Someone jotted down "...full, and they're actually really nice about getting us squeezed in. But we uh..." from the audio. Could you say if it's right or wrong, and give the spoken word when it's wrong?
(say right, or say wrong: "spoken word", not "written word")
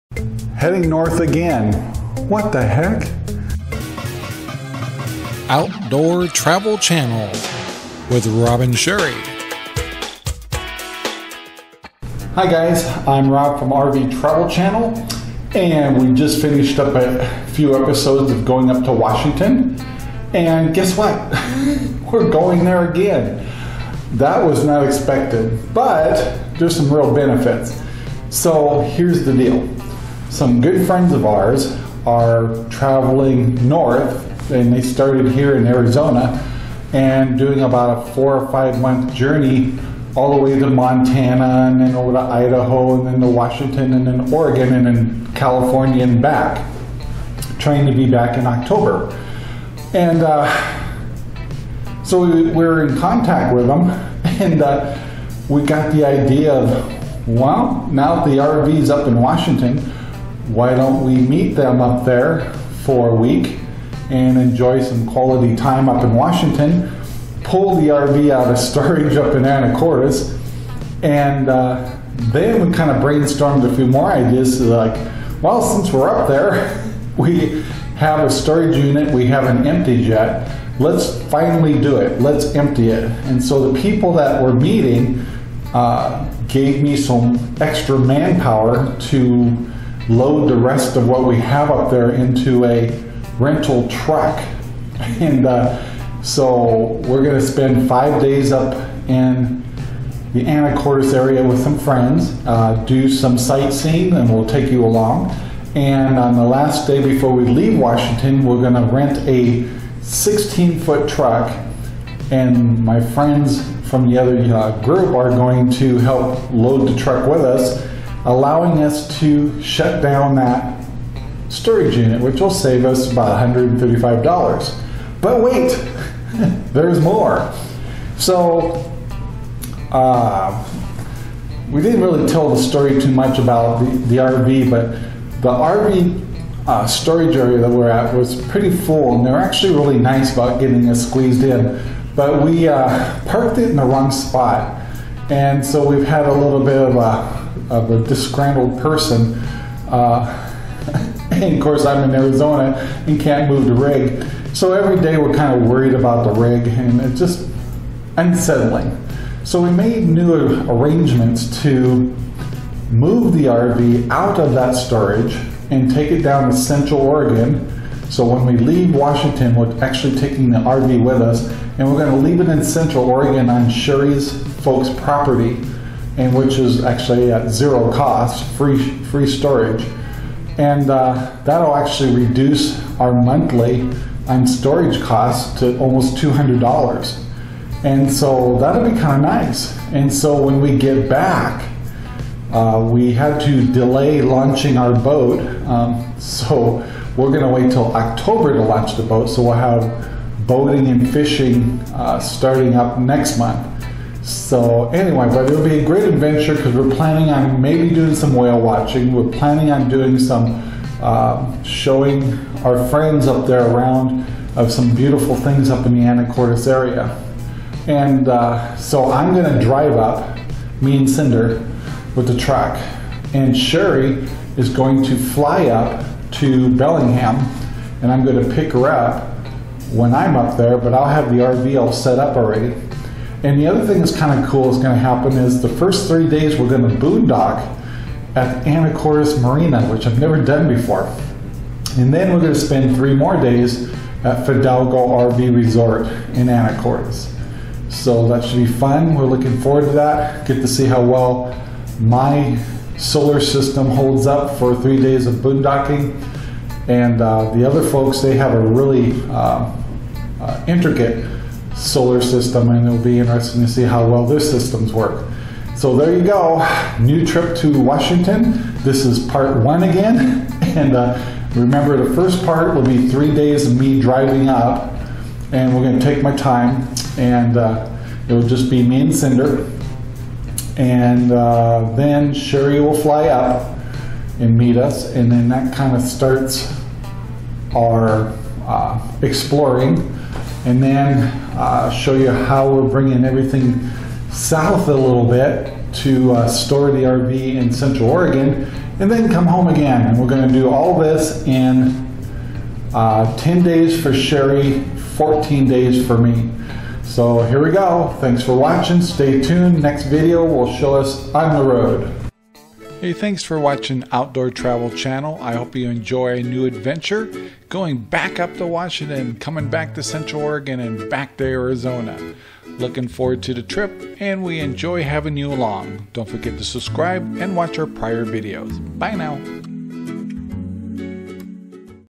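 right.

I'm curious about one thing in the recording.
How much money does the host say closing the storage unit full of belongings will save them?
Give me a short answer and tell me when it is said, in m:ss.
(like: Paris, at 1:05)
$135, at 2:03.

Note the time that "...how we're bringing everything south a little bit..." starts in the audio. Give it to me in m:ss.
4:52.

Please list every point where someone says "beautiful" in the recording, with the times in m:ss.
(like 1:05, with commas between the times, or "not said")
3:34.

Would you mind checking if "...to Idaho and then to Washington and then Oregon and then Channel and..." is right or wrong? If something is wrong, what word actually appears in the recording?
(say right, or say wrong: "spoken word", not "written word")
wrong: "California", not "Channel".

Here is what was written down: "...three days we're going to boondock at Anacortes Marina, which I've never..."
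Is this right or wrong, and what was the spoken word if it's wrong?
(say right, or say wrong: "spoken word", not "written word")
right.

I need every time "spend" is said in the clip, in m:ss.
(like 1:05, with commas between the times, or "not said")
1:37, 4:02.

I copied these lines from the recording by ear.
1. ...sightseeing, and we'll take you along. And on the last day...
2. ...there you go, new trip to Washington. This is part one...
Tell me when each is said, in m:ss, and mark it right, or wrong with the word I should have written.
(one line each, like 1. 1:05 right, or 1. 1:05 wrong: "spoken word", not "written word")
1. 1:43 right
2. 4:25 right.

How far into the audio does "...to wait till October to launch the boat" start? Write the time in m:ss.
3:17.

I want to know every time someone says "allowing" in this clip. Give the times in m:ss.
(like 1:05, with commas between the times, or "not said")
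1:58.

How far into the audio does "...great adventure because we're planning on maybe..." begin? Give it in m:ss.
3:25.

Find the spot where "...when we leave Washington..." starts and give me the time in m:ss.
2:48.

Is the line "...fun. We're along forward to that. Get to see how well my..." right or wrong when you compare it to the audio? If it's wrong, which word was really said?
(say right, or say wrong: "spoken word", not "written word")
wrong: "looking", not "along".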